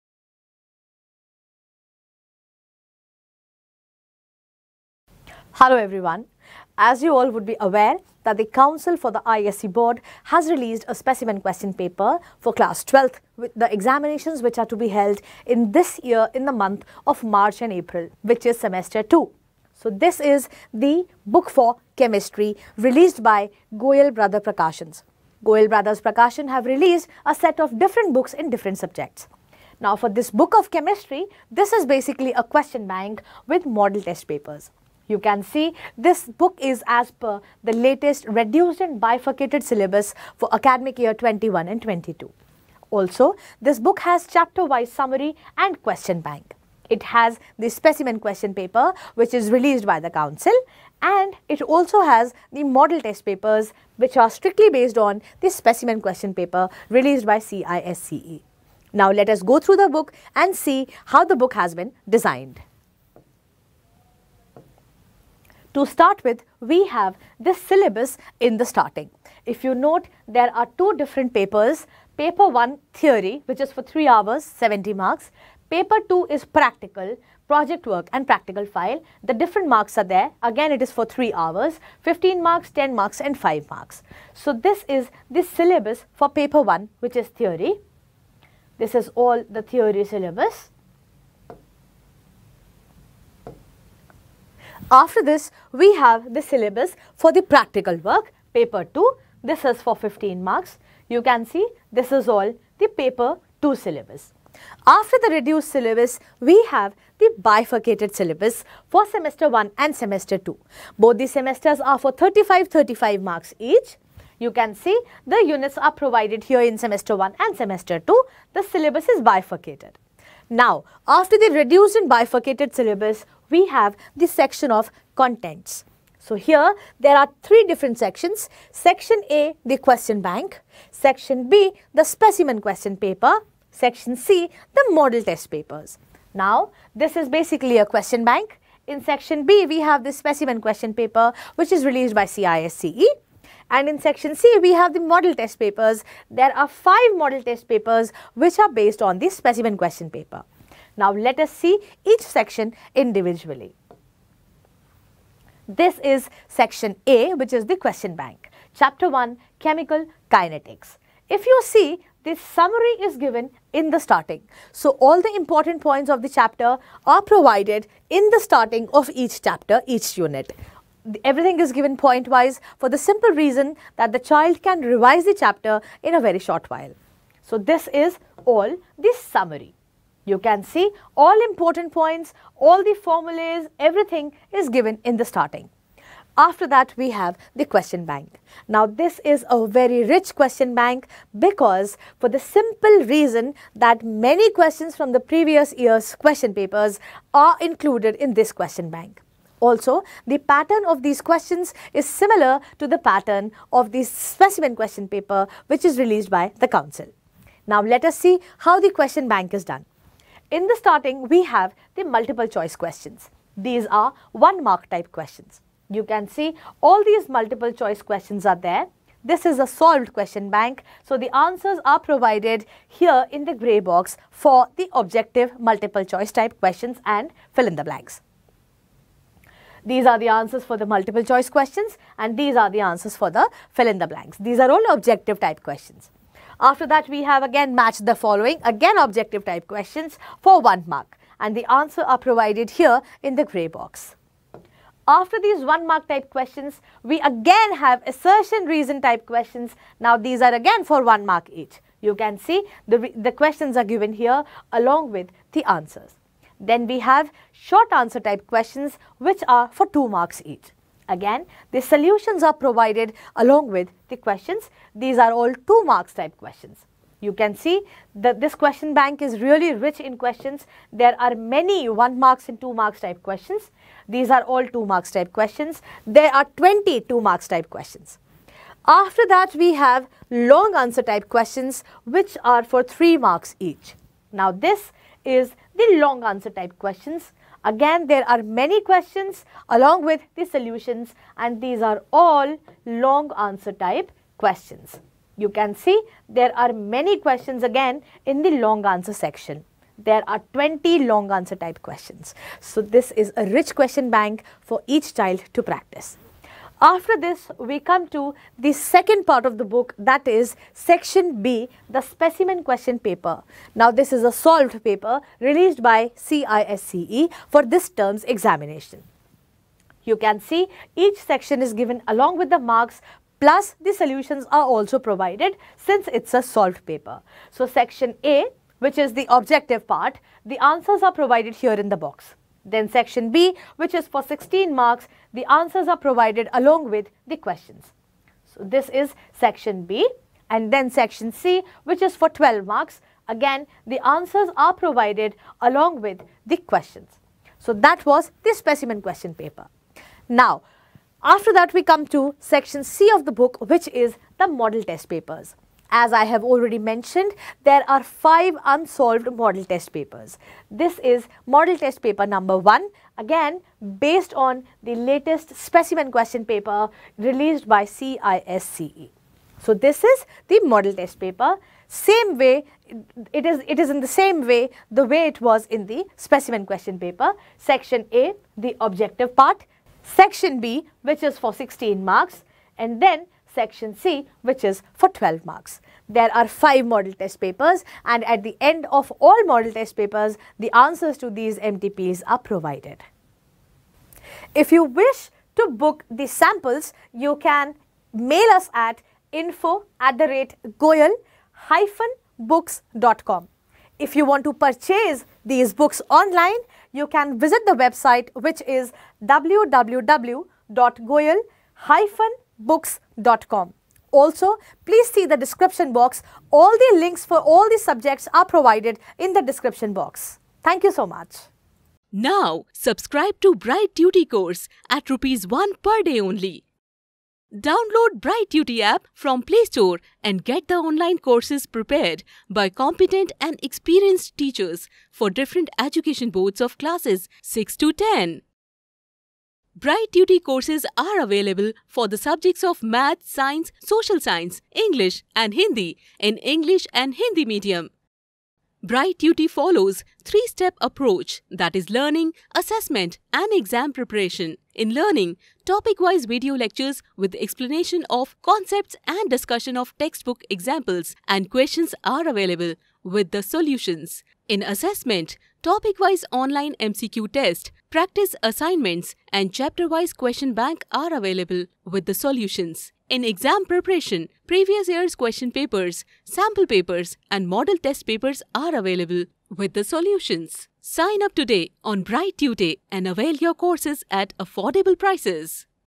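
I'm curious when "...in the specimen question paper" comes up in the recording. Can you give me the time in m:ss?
6:15.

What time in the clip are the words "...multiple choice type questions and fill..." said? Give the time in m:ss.
3:45.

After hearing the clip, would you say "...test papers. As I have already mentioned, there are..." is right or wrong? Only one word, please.
right.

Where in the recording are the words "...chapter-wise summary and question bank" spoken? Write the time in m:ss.
0:44.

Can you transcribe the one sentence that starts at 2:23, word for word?
And in section C, we have the model test papers.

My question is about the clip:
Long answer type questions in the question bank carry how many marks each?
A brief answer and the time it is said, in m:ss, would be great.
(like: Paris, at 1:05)
3, at 4:42.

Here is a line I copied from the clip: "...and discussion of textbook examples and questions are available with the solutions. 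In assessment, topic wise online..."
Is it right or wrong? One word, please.
right.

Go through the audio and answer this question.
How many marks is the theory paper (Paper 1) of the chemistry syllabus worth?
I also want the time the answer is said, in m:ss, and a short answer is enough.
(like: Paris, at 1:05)
70, at 1:14.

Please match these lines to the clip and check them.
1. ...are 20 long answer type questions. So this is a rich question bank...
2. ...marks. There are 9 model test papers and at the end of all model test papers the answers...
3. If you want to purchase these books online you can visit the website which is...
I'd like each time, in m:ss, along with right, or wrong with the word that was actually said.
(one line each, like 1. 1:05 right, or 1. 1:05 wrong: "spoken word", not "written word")
1. 5:00 right
2. 6:25 wrong: "5", not "9"
3. 6:43 right.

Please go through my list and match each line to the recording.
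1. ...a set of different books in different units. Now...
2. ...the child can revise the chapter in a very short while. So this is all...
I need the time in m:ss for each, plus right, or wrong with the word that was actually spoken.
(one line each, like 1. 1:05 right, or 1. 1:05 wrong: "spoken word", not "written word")
1. 0:27 wrong: "subjects", not "units"
2. 2:54 right.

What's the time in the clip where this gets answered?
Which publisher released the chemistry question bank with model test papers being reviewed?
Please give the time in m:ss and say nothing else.
0:23.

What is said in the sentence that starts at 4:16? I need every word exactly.
Then we have short answer type questions which are for 2 marks each.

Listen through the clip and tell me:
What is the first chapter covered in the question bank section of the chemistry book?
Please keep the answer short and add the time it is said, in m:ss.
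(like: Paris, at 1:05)
Chemical Kinetics, at 2:39.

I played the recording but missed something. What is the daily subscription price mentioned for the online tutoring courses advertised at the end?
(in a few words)
rupees 1.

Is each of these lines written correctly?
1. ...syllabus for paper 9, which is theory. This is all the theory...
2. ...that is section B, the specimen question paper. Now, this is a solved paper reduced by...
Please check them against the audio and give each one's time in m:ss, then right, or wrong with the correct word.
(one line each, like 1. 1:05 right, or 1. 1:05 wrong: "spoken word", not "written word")
1. 1:25 wrong: "1", not "9"
2. 5:09 wrong: "released", not "reduced".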